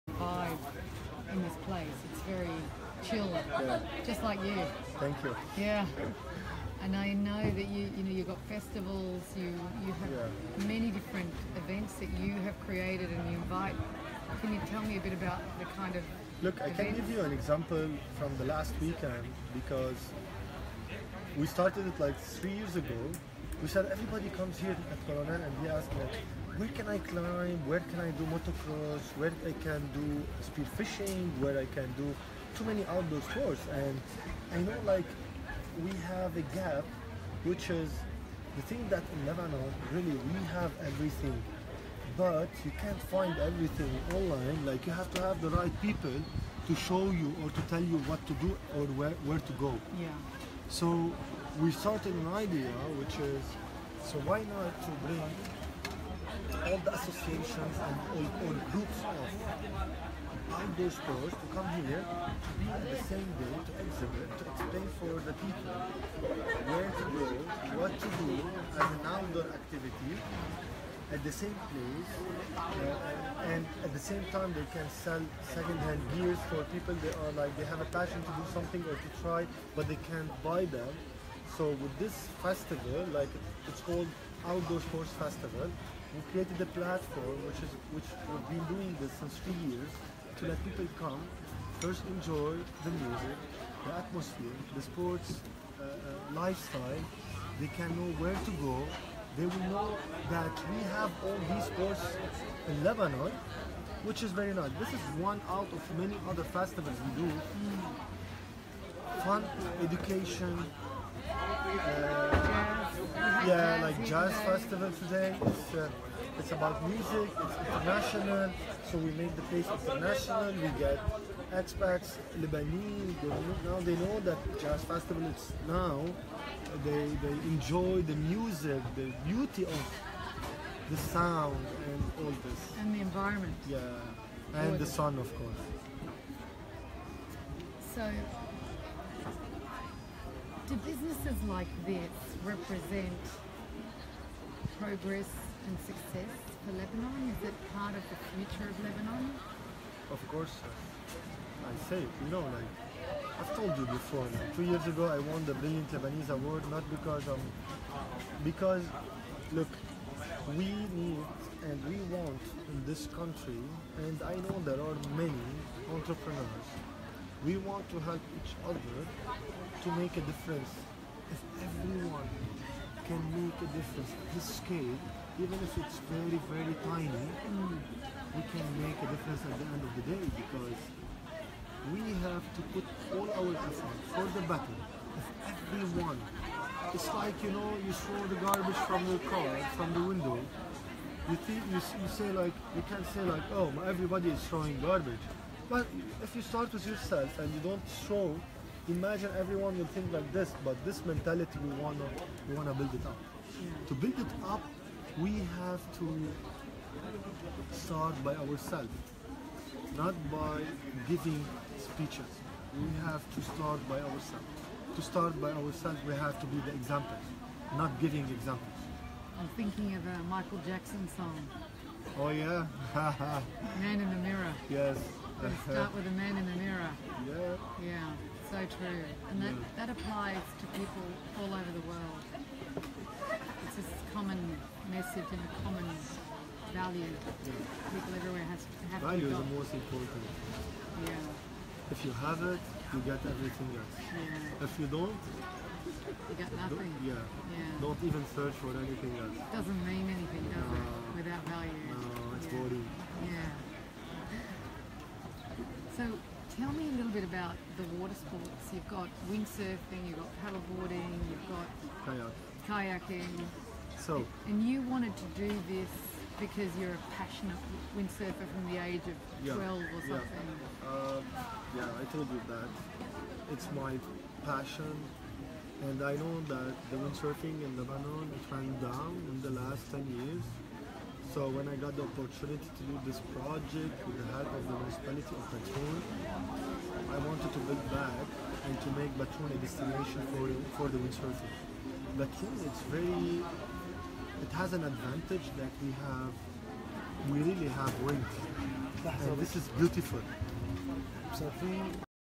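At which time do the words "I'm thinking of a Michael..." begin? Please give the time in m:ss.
3:39.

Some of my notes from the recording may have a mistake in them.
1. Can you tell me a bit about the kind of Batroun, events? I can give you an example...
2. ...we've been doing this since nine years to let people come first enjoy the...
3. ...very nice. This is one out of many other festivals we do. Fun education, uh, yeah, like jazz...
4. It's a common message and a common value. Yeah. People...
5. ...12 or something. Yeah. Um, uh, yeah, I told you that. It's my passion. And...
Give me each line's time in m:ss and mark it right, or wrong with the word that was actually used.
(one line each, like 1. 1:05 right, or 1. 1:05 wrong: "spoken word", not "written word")
1. 0:14 wrong: "Look", not "Batroun"
2. 1:28 wrong: "three", not "nine"
3. 1:44 right
4. 3:53 right
5. 4:29 right.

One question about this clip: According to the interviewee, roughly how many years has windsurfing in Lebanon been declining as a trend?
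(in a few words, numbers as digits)
10.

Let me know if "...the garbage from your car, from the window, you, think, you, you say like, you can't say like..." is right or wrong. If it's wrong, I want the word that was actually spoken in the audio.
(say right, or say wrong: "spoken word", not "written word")
right.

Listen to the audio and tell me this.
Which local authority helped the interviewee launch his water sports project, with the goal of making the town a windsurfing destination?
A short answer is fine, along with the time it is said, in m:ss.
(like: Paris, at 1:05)
Municipality of Batroun, at 4:44.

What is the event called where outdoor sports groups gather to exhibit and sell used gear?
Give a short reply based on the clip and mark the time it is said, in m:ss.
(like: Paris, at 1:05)
Outdoor Sports Festival, at 1:24.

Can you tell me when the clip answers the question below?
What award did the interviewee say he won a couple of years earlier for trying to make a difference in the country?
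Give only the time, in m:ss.
2:35.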